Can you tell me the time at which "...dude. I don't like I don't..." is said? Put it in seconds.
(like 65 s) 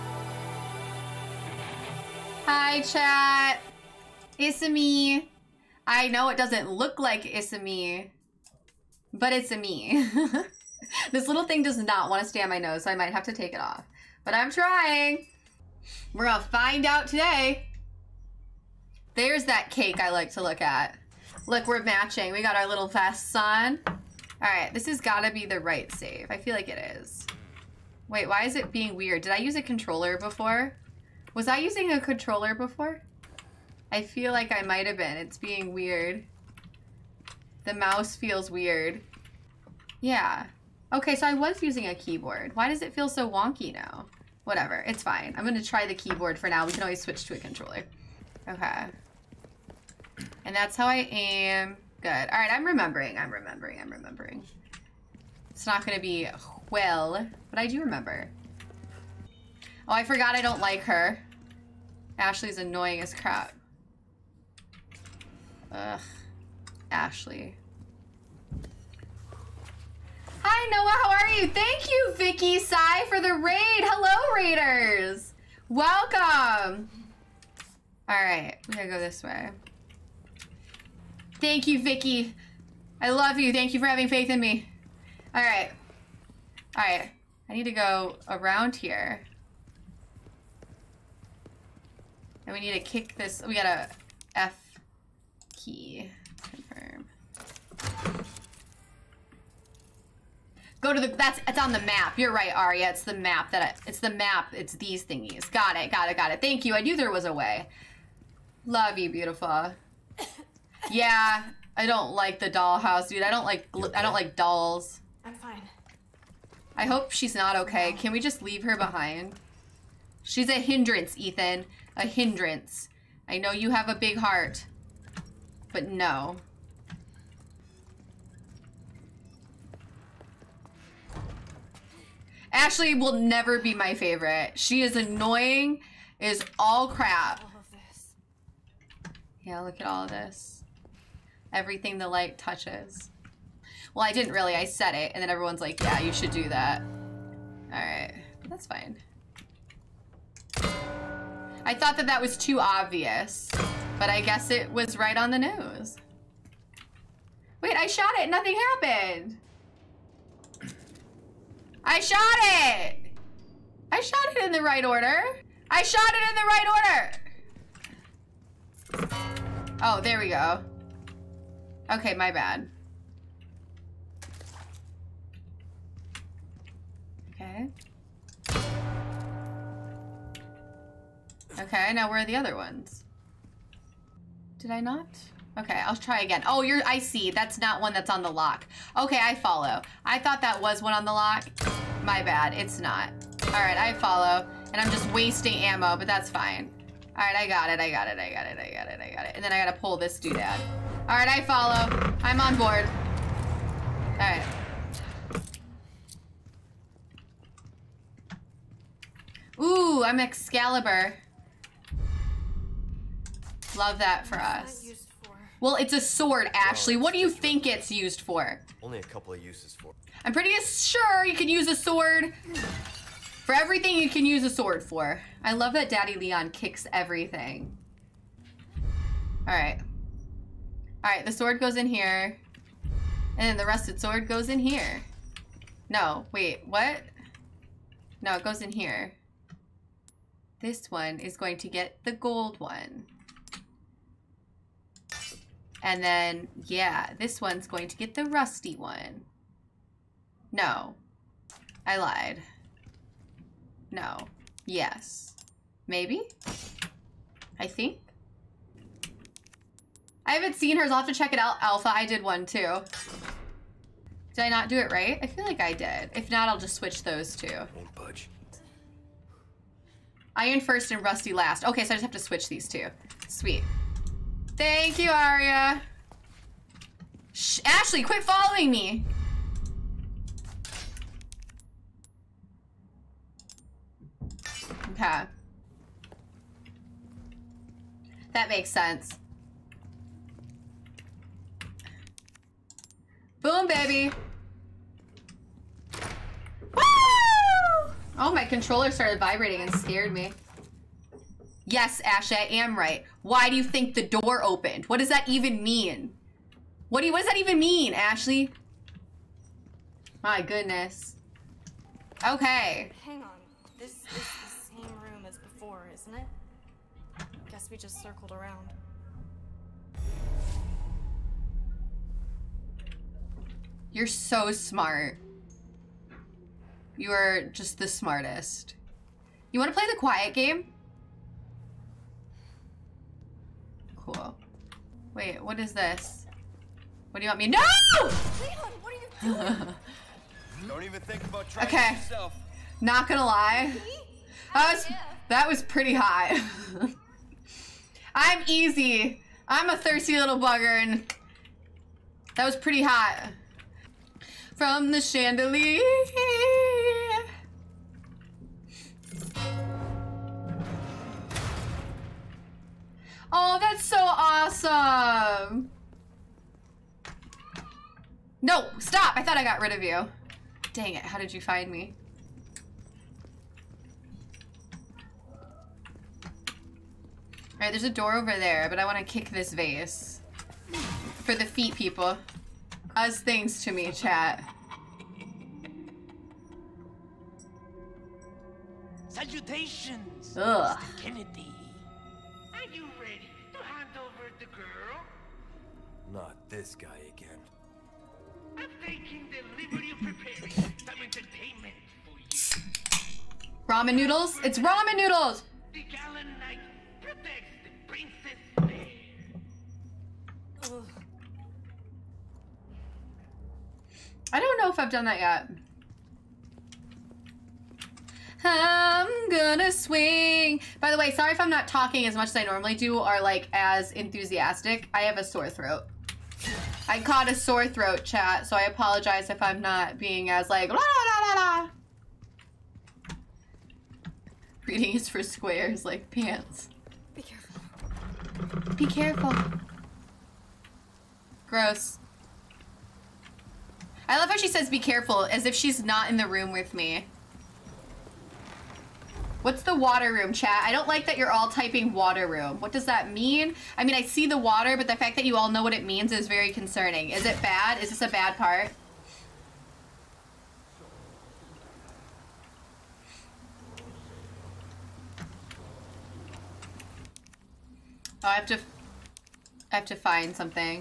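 113 s.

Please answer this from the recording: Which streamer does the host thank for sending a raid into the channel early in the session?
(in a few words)
Vicky Sai.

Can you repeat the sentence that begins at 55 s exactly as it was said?
It's not gonna be well, but I do remember.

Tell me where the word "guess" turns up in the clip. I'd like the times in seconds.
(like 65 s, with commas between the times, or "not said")
154 s, 317 s.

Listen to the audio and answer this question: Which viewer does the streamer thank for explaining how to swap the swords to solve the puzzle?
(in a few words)
Aria.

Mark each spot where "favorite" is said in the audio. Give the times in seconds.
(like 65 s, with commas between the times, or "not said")
133 s.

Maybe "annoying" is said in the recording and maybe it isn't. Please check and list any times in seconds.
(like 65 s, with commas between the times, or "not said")
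62 s, 134 s.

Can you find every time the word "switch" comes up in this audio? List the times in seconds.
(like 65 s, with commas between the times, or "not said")
47 s, 266 s, 272 s.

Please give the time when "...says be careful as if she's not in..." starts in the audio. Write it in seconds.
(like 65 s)
444 s.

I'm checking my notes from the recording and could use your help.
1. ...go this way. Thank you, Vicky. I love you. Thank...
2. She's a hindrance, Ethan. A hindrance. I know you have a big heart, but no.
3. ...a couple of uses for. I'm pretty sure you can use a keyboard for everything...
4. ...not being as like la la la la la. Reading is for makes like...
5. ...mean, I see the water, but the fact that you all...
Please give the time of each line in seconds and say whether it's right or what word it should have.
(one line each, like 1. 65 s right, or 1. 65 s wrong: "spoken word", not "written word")
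1. 78 s right
2. 120 s right
3. 218 s wrong: "sword", not "keyboard"
4. 429 s wrong: "squares", not "makes"
5. 453 s right.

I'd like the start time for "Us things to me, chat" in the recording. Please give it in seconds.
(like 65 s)
382 s.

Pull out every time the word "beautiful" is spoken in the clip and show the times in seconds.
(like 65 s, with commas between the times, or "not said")
109 s.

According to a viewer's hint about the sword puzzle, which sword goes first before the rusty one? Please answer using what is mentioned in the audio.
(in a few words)
Iron.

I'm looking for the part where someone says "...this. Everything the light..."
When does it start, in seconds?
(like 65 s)
140 s.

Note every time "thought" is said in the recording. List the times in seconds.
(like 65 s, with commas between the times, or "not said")
151 s, 190 s, 369 s.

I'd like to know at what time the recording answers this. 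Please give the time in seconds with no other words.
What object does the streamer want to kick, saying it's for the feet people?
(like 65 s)
379 s.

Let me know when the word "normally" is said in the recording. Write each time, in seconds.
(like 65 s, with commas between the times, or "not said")
422 s.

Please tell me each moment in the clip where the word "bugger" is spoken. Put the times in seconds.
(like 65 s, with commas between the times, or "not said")
350 s.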